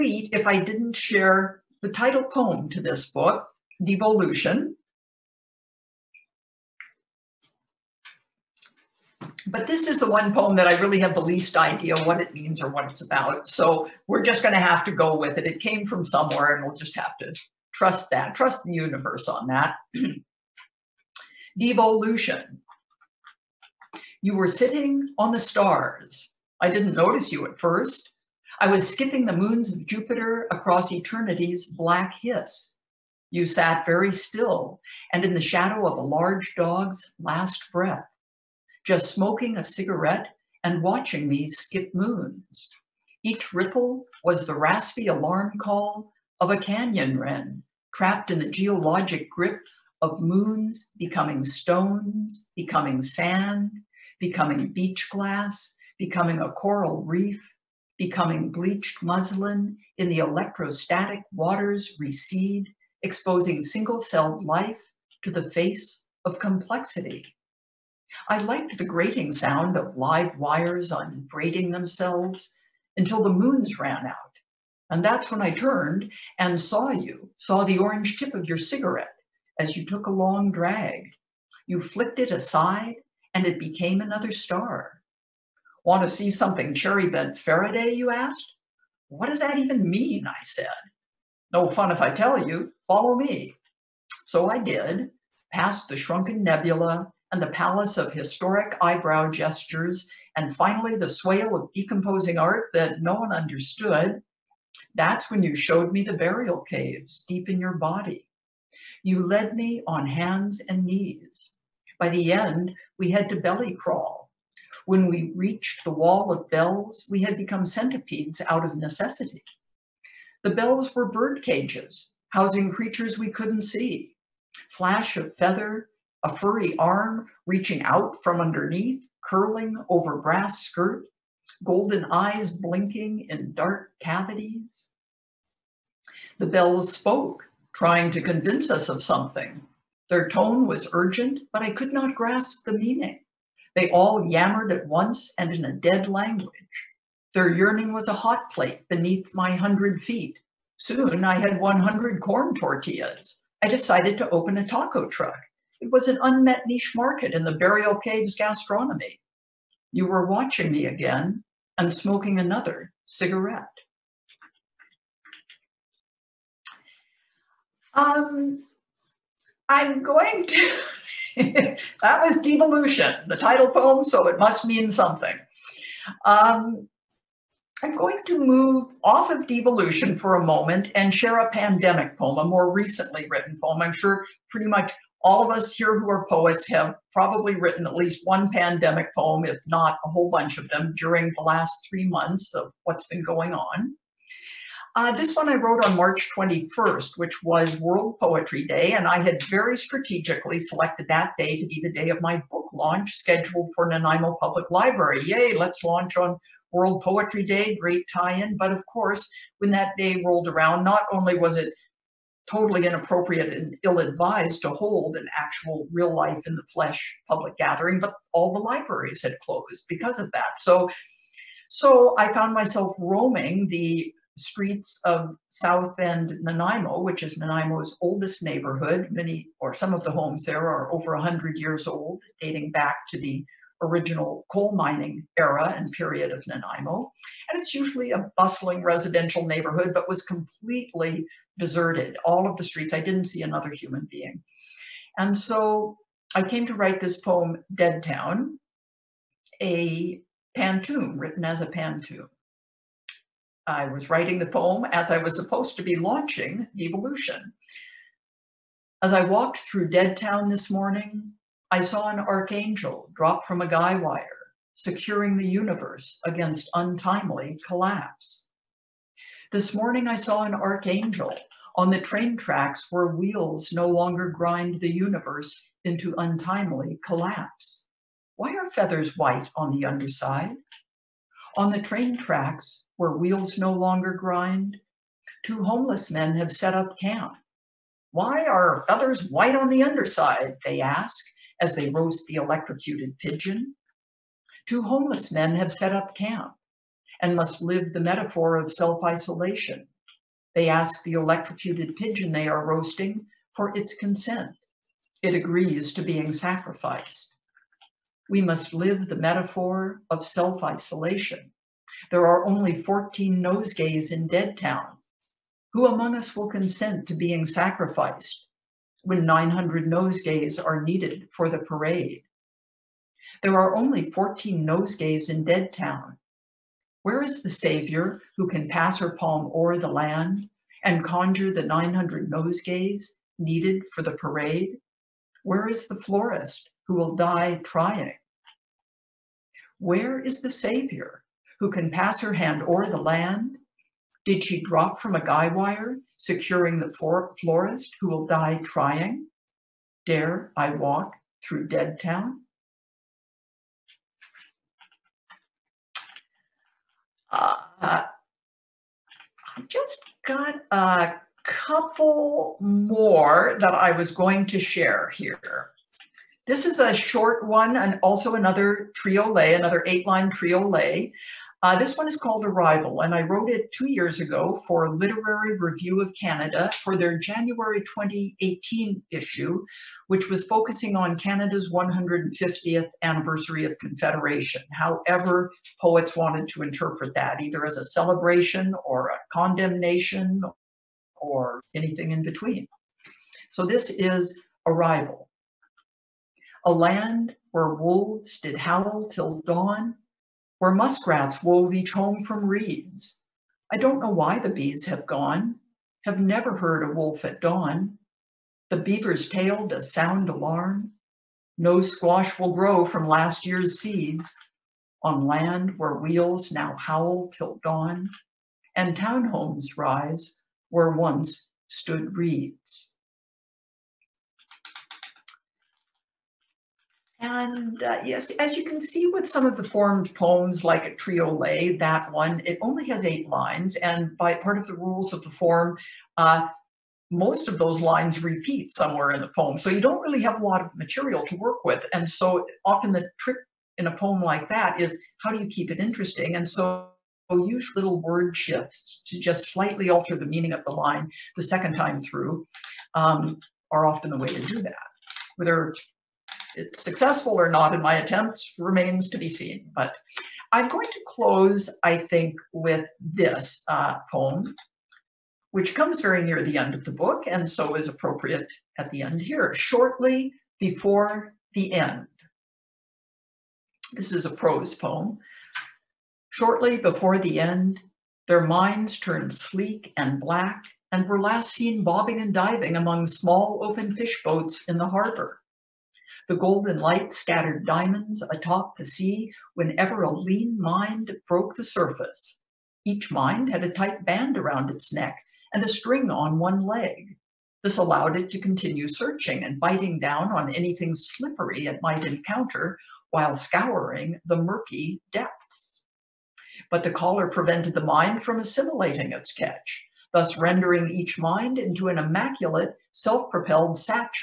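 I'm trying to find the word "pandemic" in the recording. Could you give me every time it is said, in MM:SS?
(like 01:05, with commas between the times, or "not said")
03:01, 03:08.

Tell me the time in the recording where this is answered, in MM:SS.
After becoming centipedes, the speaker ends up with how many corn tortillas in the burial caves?
02:31.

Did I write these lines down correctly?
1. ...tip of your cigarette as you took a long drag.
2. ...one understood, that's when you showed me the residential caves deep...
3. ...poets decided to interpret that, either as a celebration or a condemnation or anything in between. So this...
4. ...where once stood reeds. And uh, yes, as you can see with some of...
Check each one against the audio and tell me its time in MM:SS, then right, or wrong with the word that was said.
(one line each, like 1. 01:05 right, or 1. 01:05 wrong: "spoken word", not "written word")
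1. 01:18 right
2. 01:43 wrong: "burial", not "residential"
3. 06:25 wrong: "wanted", not "decided"
4. 07:00 right.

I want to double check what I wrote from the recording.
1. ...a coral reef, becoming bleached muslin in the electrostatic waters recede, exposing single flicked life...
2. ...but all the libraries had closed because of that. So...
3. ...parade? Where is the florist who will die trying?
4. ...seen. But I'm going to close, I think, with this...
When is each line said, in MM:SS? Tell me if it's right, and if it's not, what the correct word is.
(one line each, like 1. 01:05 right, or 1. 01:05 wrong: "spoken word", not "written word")
1. 00:56 wrong: "celled", not "flicked"
2. 03:37 right
3. 05:34 right
4. 07:39 right.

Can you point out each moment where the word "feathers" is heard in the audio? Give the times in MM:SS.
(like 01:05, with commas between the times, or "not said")
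02:05, 04:38, 04:48.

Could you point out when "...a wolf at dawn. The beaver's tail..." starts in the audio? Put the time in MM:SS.
06:46.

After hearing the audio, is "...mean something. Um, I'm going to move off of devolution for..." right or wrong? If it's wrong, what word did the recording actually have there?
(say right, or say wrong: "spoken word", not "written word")
right.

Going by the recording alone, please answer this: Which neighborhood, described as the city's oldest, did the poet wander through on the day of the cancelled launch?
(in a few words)
South End Nanaimo.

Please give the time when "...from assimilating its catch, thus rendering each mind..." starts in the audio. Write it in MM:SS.
08:28.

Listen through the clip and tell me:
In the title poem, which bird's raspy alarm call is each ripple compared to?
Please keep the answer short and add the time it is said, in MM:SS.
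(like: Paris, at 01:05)
Canyon wren, at 00:46.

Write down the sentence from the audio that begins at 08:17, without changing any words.
This allowed it to continue searching and biting down on anything slippery it might encounter while scouring the murky depths.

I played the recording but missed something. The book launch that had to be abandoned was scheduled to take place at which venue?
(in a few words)
Nanaimo Public Library.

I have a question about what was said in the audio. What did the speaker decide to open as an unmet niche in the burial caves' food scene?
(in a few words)
A taco truck.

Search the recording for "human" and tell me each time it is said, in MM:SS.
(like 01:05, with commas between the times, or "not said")
04:03.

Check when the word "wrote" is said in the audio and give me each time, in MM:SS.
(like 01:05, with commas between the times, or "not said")
03:15, 06:13.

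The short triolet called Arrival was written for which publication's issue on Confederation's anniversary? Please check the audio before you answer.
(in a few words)
Literary Review of Canada.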